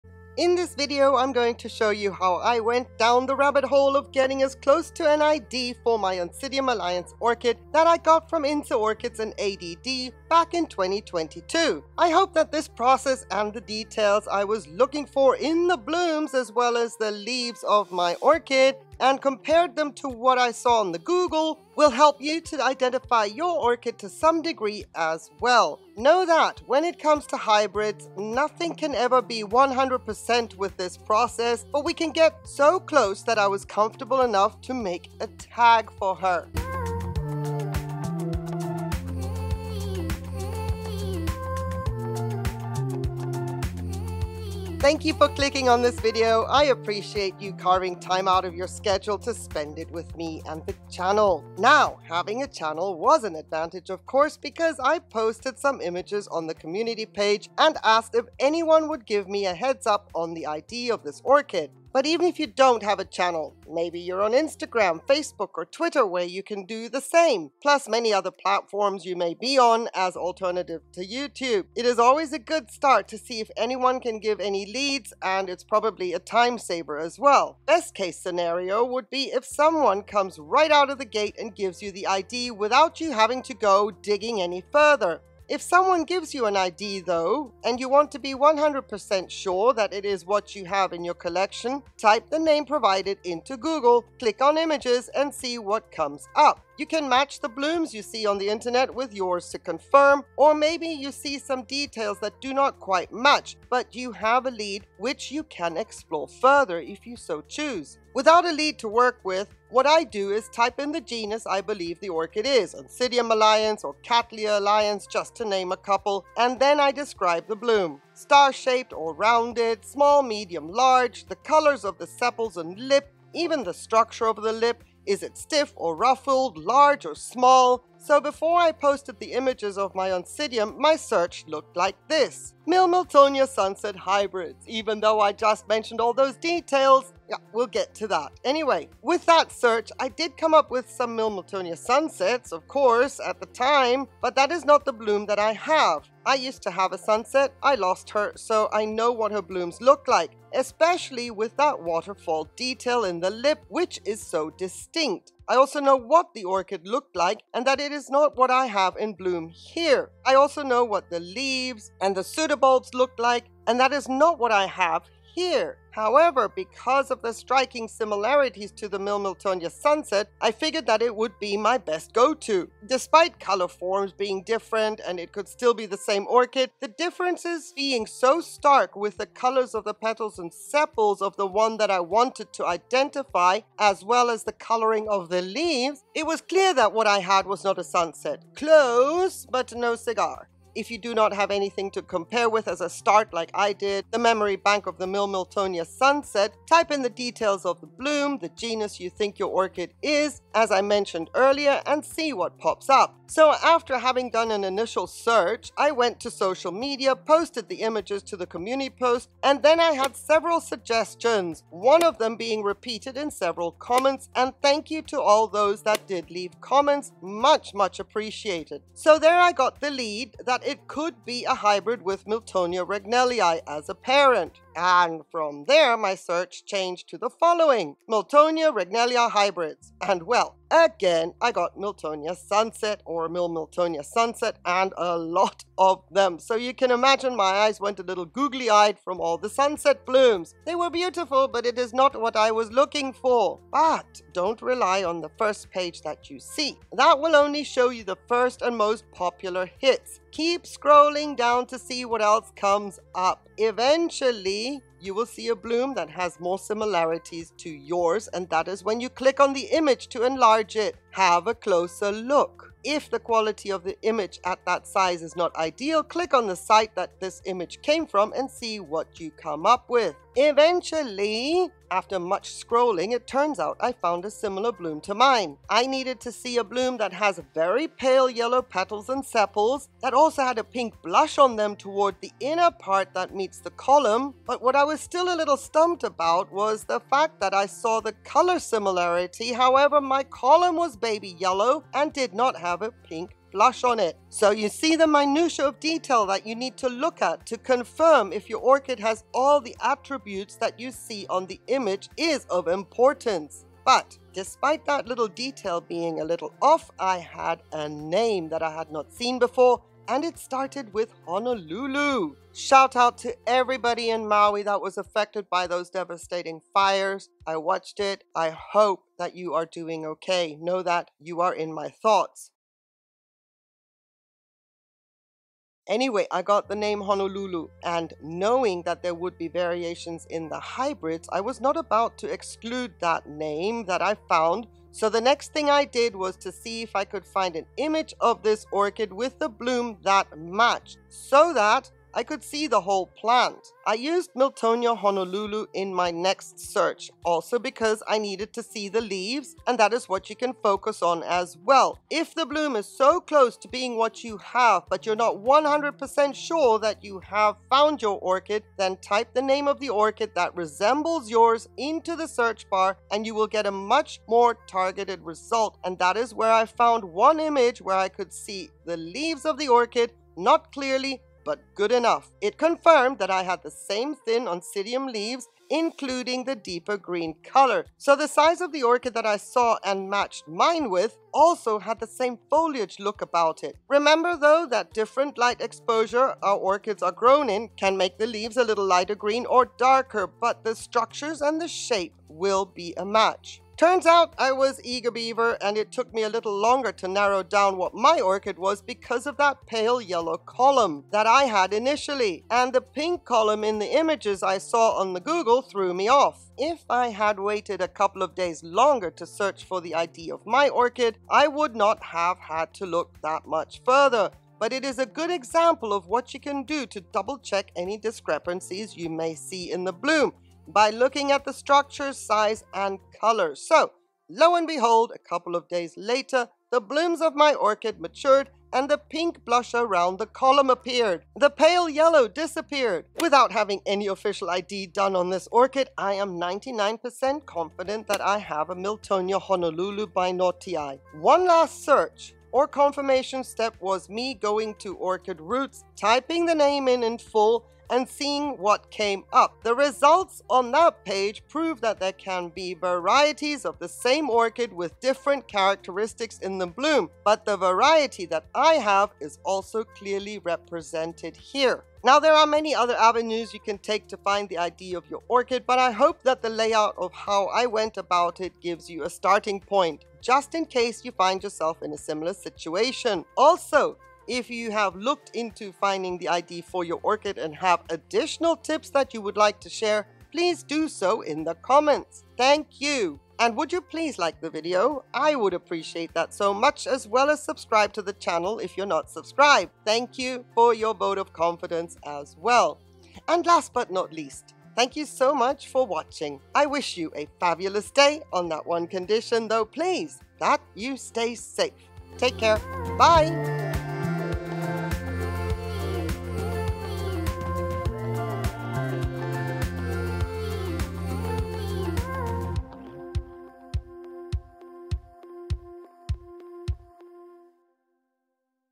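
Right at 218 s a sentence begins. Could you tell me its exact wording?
So there I got the lead that it could be a hybrid with Miltonia regnellii as a parent.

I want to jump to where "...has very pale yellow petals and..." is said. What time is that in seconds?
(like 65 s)
277 s.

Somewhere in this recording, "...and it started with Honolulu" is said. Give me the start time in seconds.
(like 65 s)
310 s.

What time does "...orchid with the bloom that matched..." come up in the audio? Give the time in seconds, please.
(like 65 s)
338 s.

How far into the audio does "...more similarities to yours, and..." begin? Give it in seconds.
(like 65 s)
256 s.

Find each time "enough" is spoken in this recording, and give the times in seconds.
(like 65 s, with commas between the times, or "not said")
34 s, 371 s.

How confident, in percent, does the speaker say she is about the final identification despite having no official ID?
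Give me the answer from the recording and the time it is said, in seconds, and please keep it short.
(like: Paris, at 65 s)
99%, at 436 s.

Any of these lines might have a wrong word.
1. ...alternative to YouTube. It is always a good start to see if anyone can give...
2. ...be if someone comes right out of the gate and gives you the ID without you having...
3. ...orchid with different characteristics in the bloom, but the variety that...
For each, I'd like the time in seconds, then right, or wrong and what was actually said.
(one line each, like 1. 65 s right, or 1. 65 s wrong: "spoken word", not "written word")
1. 70 s right
2. 79 s right
3. 454 s right.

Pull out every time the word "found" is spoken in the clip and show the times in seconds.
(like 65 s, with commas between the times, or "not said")
273 s, 334 s, 357 s, 366 s.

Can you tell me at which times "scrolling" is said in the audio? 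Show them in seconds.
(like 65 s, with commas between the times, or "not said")
250 s, 272 s.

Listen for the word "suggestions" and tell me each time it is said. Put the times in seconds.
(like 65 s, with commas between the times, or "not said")
210 s.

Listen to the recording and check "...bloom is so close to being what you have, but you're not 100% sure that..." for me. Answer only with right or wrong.
right.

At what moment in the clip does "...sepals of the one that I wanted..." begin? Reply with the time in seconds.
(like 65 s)
180 s.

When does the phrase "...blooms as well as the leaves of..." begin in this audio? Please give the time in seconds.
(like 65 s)
15 s.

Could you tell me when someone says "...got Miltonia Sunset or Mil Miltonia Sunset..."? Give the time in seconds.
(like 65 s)
231 s.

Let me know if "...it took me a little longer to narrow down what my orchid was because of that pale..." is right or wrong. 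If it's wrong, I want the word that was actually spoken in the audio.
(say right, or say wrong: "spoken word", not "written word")
right.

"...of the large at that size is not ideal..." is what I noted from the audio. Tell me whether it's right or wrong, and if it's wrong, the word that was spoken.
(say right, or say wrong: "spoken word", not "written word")
wrong: "image", not "large".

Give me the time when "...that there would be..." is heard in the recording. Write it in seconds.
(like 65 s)
328 s.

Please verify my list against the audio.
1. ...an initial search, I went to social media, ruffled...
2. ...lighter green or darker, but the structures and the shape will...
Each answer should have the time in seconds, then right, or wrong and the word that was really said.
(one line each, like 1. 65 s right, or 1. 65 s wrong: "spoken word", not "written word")
1. 204 s wrong: "posted", not "ruffled"
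2. 388 s right.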